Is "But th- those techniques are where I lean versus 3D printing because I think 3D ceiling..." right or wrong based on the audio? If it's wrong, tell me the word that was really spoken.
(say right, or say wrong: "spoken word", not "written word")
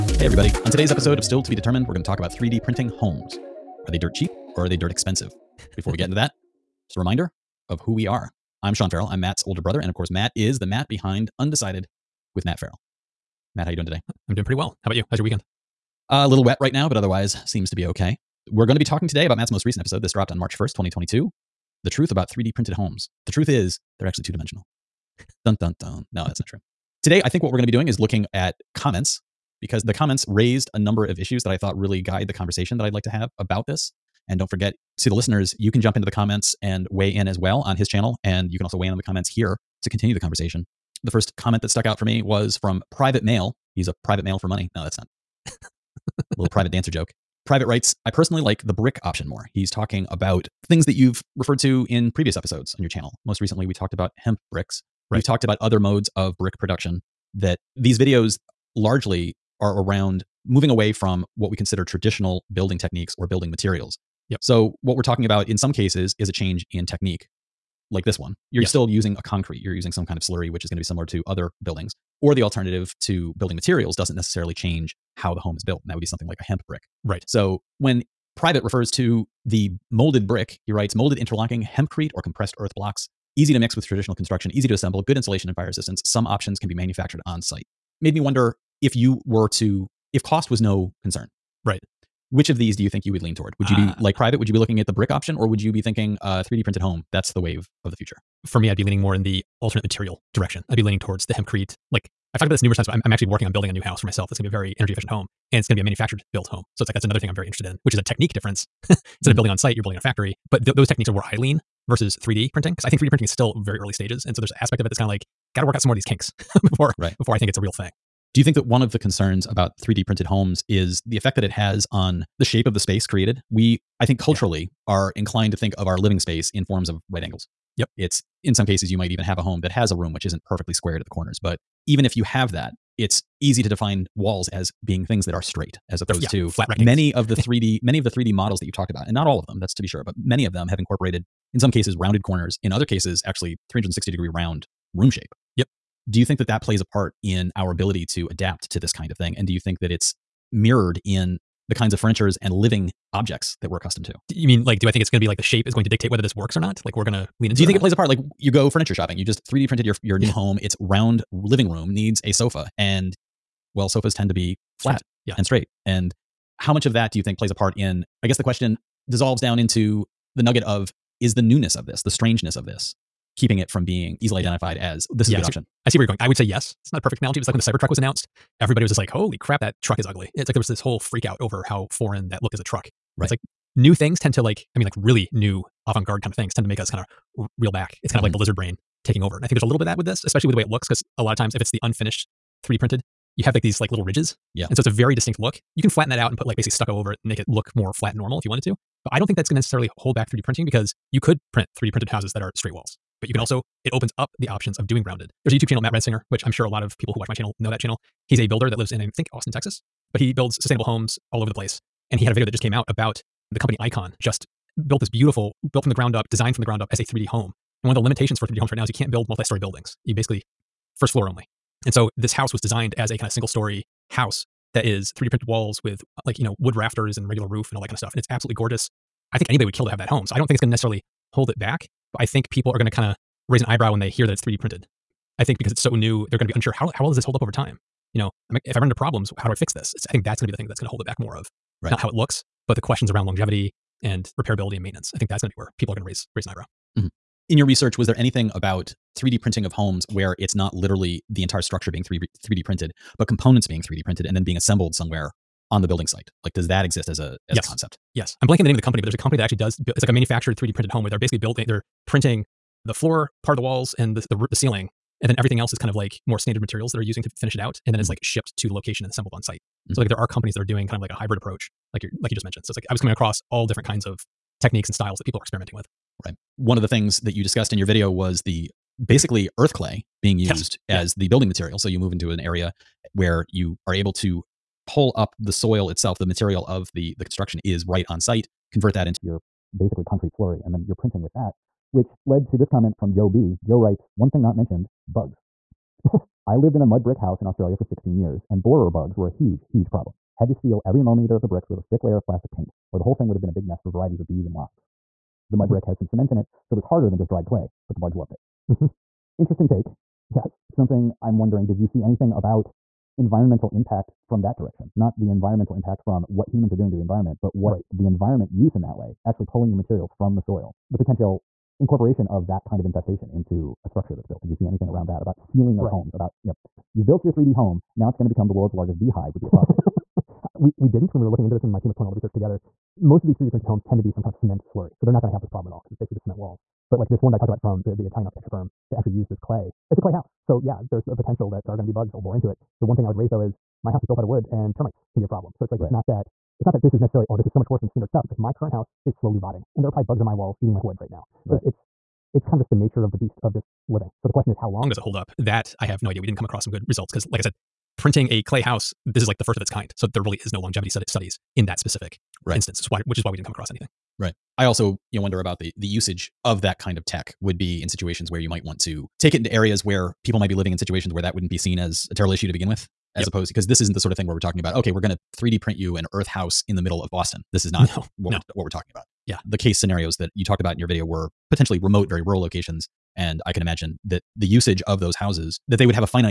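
wrong: "printing", not "ceiling".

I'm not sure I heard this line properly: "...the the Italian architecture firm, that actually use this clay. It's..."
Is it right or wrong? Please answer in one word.
right.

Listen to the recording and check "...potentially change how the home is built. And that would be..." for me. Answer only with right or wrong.
wrong.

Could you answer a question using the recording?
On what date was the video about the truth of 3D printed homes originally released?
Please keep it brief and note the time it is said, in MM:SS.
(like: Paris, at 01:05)
March 1st, 2022, at 00:20.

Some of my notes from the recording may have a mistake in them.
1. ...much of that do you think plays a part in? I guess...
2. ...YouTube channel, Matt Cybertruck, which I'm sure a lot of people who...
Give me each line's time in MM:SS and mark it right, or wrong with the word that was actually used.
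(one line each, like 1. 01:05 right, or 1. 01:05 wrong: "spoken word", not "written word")
1. 02:46 right
2. 03:25 wrong: "Risinger", not "Cybertruck".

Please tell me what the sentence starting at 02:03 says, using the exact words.
We I think culturally are inclined to think of our living space in forms of right angles.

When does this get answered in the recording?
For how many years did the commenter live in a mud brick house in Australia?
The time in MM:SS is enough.
04:57.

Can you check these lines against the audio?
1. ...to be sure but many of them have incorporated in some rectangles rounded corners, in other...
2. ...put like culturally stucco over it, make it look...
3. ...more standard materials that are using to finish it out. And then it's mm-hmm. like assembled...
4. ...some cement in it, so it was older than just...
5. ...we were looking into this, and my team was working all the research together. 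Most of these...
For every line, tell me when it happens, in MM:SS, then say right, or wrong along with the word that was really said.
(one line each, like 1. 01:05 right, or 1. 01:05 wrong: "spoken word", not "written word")
1. 02:19 wrong: "cases", not "rectangles"
2. 03:16 wrong: "basically", not "culturally"
3. 04:26 wrong: "shipped", not "assembled"
4. 05:05 wrong: "harder", not "older"
5. 05:31 wrong: "pulling", not "working".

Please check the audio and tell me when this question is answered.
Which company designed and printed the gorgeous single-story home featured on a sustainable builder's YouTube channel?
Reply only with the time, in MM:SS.
03:33.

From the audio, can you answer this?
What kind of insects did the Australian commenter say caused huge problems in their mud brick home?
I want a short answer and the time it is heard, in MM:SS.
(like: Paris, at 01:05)
borer bugs, at 04:58.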